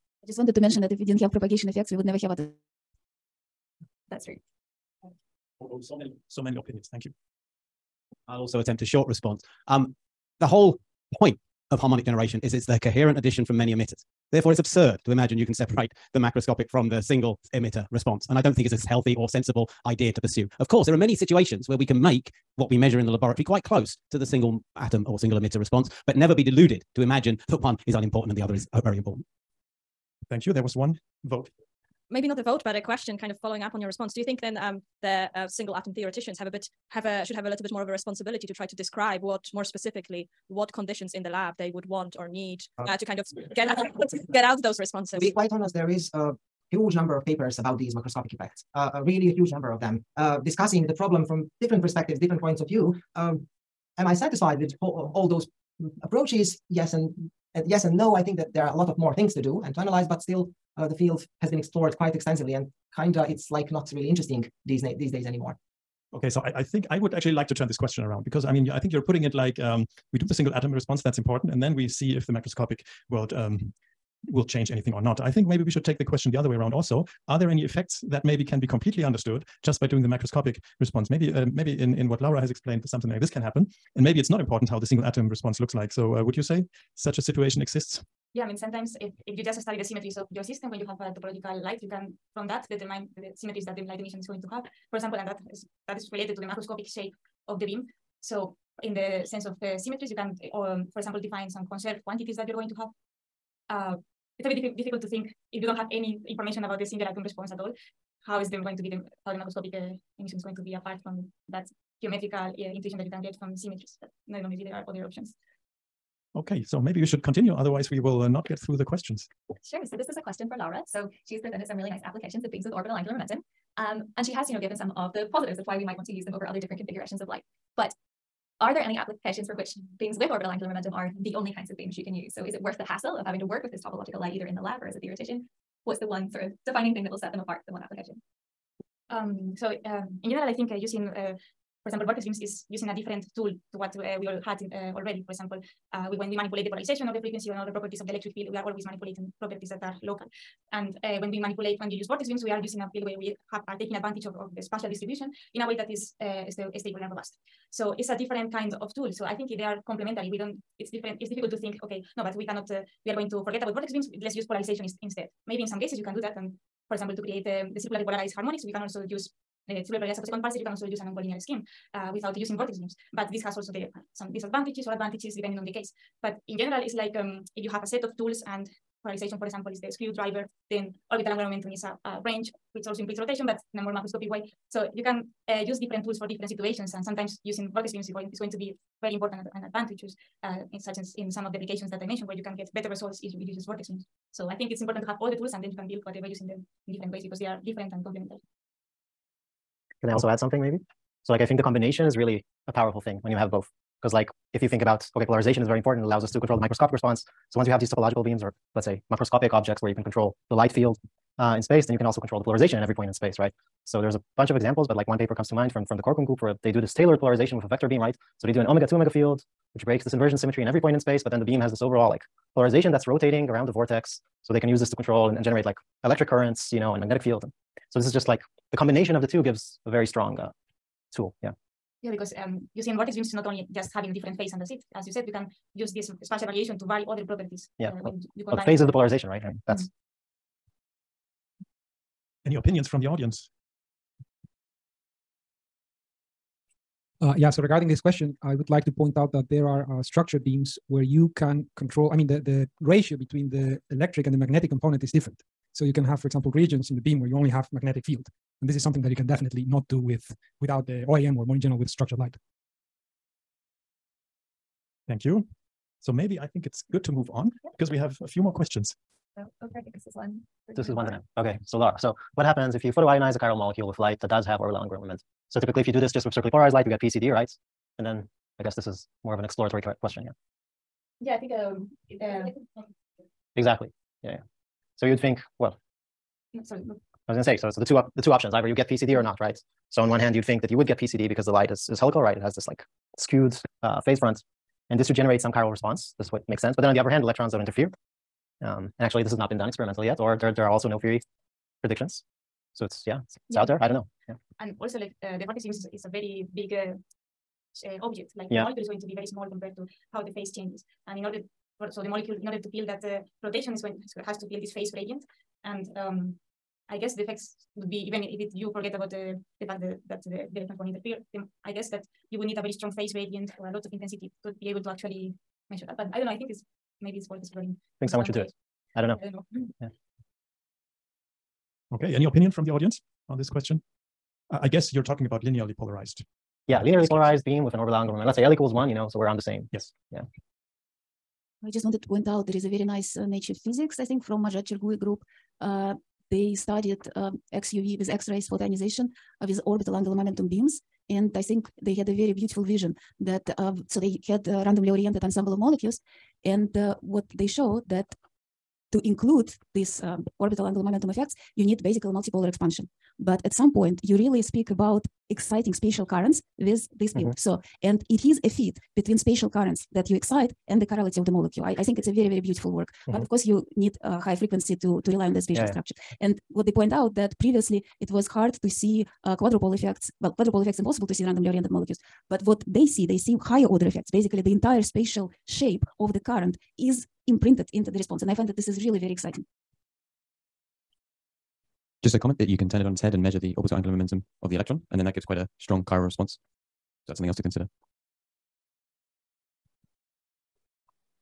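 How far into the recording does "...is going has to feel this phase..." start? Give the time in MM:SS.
05:13.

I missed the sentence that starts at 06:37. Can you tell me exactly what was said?
Is that's something else to consider.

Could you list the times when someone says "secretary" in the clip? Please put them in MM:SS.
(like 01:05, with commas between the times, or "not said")
not said.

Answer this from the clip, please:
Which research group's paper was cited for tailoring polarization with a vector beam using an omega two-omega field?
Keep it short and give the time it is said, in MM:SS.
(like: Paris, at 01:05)
Corkum group, at 03:36.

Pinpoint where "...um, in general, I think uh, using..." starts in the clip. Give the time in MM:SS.
02:19.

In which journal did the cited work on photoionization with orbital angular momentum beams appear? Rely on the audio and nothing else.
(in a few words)
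Nature Physics.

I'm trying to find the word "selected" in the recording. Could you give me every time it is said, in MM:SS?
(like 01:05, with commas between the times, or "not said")
not said.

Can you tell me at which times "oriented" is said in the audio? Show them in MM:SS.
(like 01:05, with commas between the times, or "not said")
05:54, 06:21.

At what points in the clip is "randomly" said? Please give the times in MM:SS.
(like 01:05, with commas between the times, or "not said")
05:54, 06:21.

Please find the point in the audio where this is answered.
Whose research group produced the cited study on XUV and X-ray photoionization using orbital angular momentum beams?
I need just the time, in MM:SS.
05:44.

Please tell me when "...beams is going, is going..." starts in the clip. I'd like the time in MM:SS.
03:07.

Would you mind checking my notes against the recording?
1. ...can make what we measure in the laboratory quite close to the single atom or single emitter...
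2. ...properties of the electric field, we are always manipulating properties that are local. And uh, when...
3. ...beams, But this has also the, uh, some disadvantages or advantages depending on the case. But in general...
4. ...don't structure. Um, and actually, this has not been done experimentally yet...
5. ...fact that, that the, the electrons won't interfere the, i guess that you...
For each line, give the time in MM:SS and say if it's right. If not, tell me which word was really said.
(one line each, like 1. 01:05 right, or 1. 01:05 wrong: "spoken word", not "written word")
1. 00:21 right
2. 02:27 right
3. 02:52 right
4. 04:57 wrong: "interfere", not "structure"
5. 05:19 right.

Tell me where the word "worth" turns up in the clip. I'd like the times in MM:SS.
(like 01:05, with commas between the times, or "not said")
02:12, 05:27.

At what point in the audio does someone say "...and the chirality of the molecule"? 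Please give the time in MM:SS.
06:10.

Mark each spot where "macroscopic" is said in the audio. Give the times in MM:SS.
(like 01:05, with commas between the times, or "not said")
00:16, 00:47, 01:12, 01:20, 01:36, 01:49, 03:03, 03:29.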